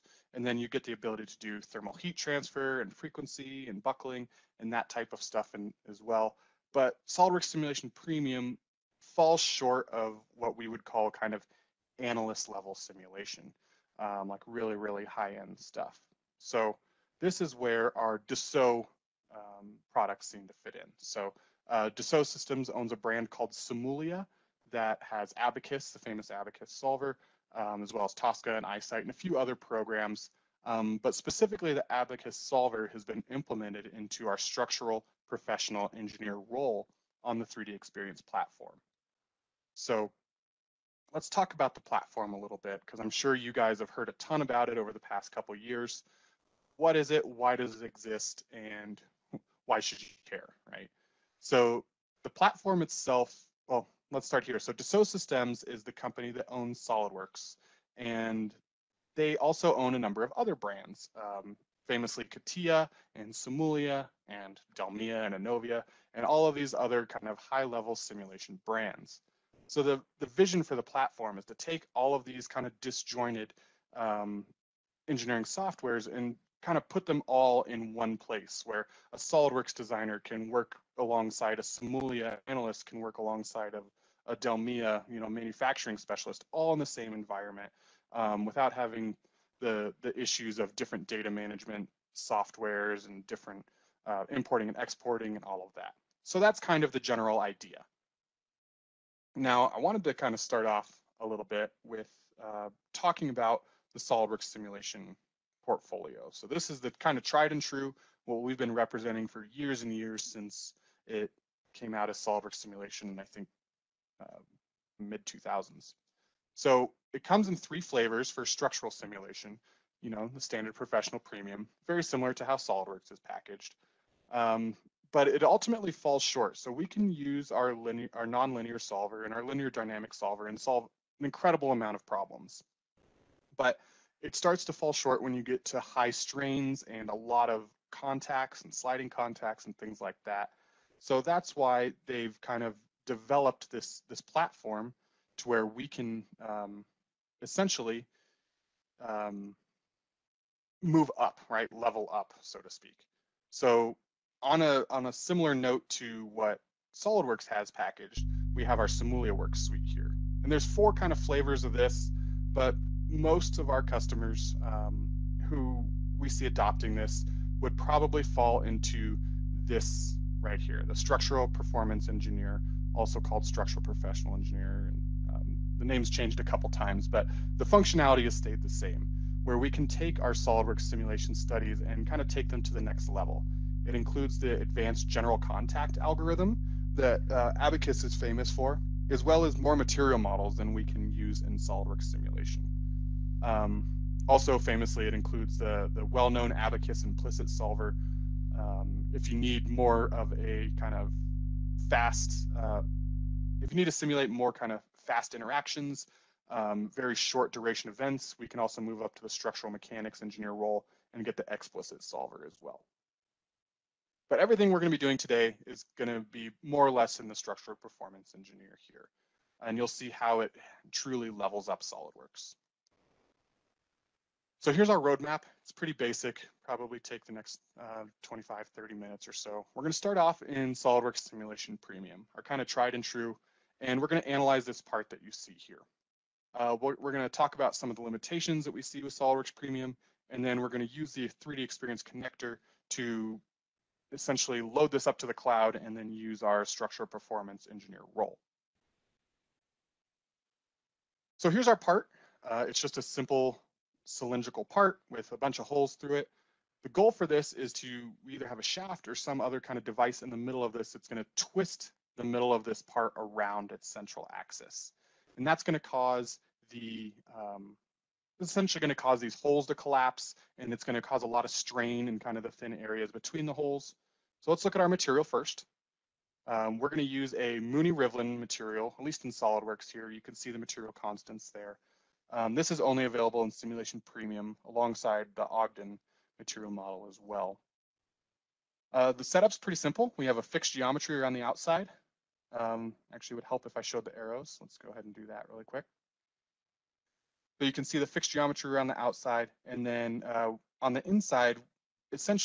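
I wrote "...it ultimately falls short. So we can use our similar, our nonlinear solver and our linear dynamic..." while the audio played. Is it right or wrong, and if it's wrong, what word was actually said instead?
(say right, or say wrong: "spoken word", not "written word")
wrong: "linear", not "similar".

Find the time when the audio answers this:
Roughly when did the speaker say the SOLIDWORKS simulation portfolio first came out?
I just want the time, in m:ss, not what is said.
1:54.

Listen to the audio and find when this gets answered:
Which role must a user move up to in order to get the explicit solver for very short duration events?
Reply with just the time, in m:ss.
3:29.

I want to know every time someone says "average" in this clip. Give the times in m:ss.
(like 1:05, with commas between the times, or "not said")
not said.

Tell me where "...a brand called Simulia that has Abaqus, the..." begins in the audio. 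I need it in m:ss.
0:22.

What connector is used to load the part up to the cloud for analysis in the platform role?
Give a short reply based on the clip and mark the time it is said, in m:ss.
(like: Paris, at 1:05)
3D Experience connector, at 4:01.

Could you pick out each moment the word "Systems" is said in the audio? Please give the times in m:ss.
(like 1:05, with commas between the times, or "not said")
0:22, 0:55.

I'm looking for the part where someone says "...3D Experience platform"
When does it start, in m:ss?
0:37.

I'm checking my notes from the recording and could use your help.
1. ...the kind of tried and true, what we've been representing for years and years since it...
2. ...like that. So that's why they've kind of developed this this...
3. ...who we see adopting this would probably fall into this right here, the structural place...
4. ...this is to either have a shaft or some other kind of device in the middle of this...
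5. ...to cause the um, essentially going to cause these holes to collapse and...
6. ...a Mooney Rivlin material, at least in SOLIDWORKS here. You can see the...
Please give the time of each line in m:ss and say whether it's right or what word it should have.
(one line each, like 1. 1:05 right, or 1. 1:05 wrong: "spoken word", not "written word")
1. 1:46 right
2. 2:20 right
3. 2:45 wrong: "performance", not "place"
4. 4:17 right
5. 4:25 right
6. 4:37 right.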